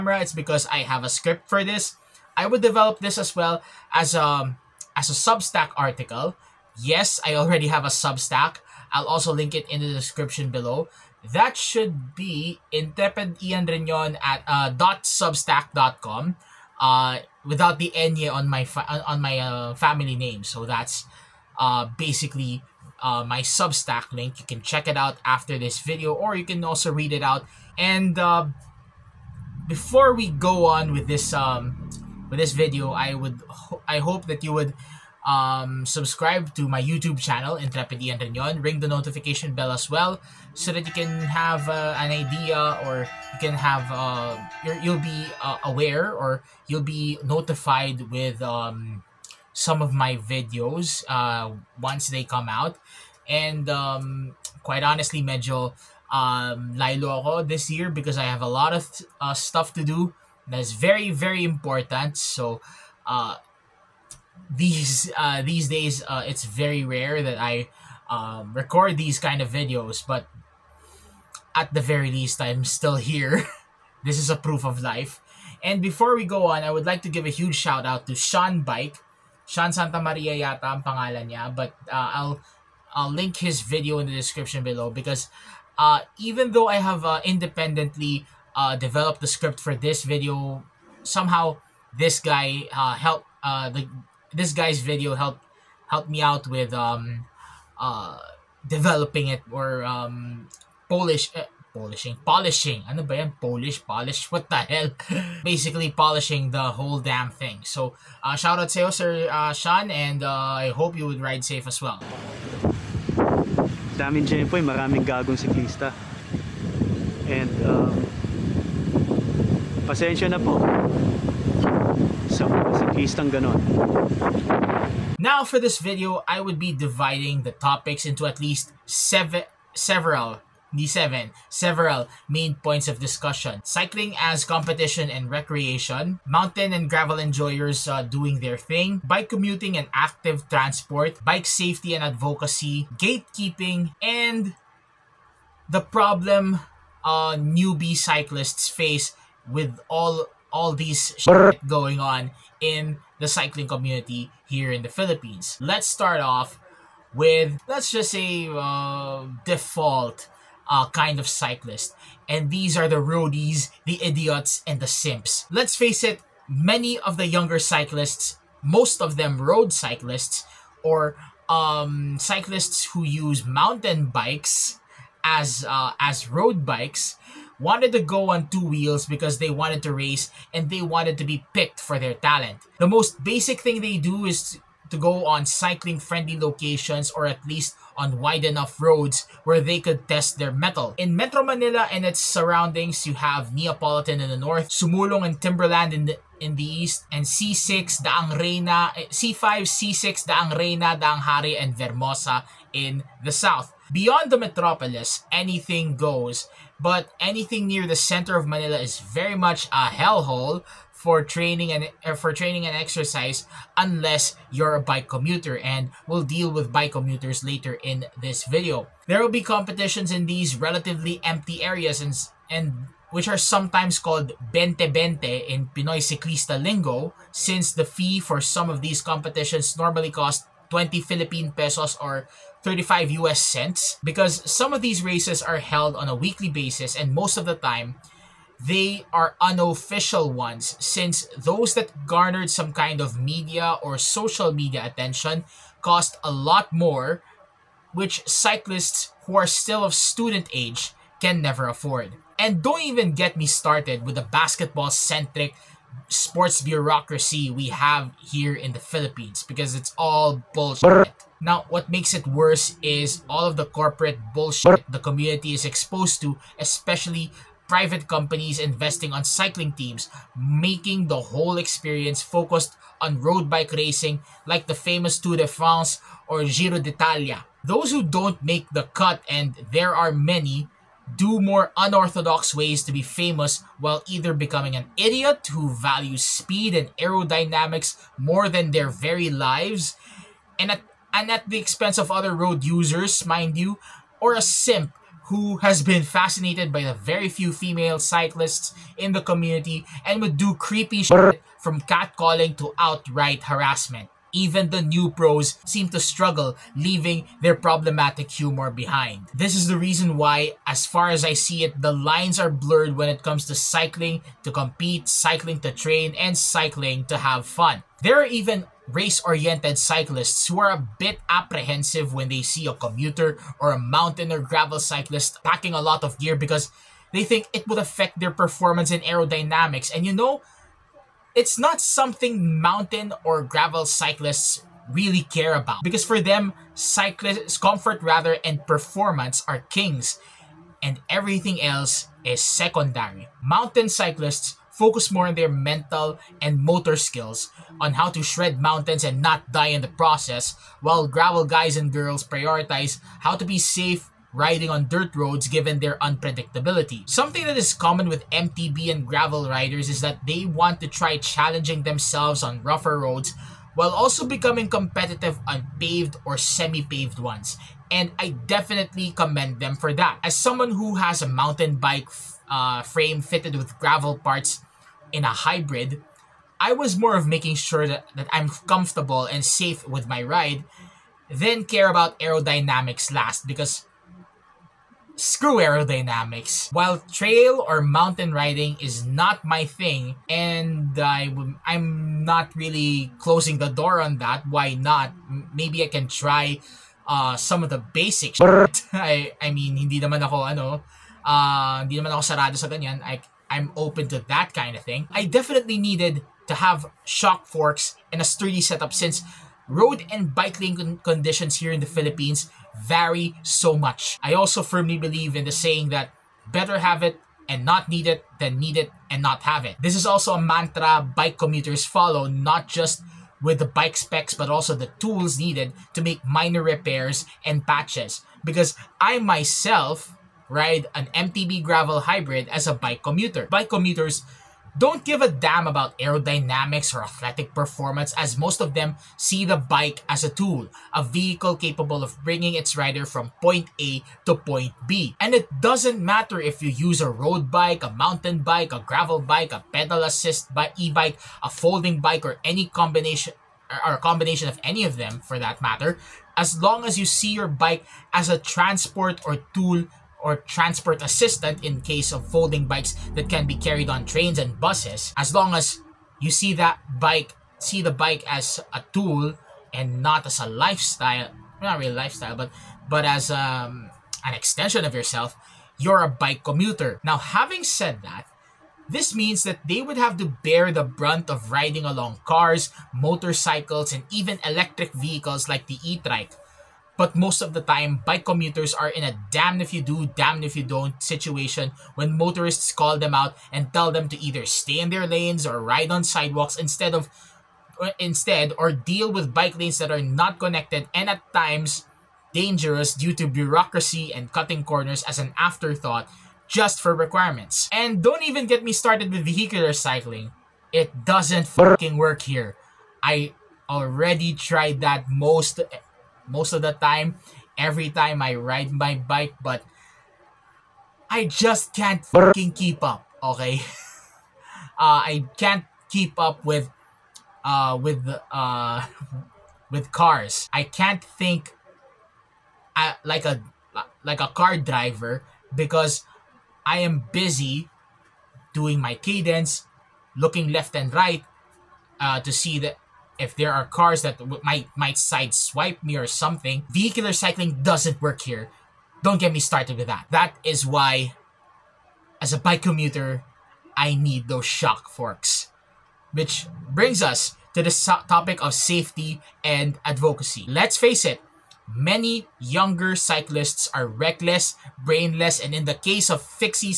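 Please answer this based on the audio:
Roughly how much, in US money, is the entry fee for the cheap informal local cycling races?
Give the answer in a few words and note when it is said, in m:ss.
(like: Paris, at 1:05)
35 US cents, at 3:52.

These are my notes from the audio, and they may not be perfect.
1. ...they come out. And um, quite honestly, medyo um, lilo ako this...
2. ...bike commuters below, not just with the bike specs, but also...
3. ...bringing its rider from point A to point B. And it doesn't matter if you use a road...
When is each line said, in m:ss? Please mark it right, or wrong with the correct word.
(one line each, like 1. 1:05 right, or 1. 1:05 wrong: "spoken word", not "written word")
1. 0:52 right
2. 7:01 wrong: "follow", not "below"
3. 7:22 right.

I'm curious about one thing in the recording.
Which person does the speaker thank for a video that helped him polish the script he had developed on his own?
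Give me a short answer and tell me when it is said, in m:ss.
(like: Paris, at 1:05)
Sean Santa Maria, at 1:19.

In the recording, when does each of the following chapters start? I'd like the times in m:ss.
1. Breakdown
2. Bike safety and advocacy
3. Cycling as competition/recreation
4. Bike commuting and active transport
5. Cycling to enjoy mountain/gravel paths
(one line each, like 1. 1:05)
1. 2:04
2. 9:09
3. 2:35
4. 6:59
5. 5:30.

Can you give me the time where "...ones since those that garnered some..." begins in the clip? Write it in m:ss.
4:00.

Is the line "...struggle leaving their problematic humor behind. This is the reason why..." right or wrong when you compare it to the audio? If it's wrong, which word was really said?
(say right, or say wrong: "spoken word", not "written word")
right.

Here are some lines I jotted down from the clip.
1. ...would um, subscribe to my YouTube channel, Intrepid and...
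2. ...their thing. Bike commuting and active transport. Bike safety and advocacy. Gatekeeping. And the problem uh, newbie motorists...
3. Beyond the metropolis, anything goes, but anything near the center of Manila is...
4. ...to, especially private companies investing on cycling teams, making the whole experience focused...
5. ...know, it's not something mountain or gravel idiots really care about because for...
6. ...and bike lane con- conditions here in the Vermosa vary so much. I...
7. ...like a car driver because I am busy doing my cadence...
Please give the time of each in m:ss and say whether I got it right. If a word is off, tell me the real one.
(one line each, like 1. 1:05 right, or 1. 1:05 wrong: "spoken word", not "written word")
1. 0:34 right
2. 2:18 wrong: "cyclists", not "motorists"
3. 3:23 right
4. 4:26 right
5. 5:30 wrong: "cyclists", not "idiots"
6. 6:50 wrong: "Philippines", not "Vermosa"
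7. 8:54 right.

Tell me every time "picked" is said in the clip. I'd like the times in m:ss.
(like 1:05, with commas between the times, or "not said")
3:01.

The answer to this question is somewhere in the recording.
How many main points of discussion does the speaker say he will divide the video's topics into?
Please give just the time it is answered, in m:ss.
2:08.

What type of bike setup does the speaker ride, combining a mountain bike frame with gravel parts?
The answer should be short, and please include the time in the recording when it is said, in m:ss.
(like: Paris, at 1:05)
MTB gravel hybrid, at 7:11.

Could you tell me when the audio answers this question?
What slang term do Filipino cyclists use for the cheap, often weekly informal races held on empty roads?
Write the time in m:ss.
3:44.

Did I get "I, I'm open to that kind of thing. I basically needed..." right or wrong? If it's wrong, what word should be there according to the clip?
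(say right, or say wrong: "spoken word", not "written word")
wrong: "definitely", not "basically".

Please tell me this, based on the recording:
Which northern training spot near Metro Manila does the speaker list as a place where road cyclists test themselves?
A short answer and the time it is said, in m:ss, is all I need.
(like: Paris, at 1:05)
Neopolitan, at 3:13.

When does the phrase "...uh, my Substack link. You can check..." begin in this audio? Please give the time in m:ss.
0:23.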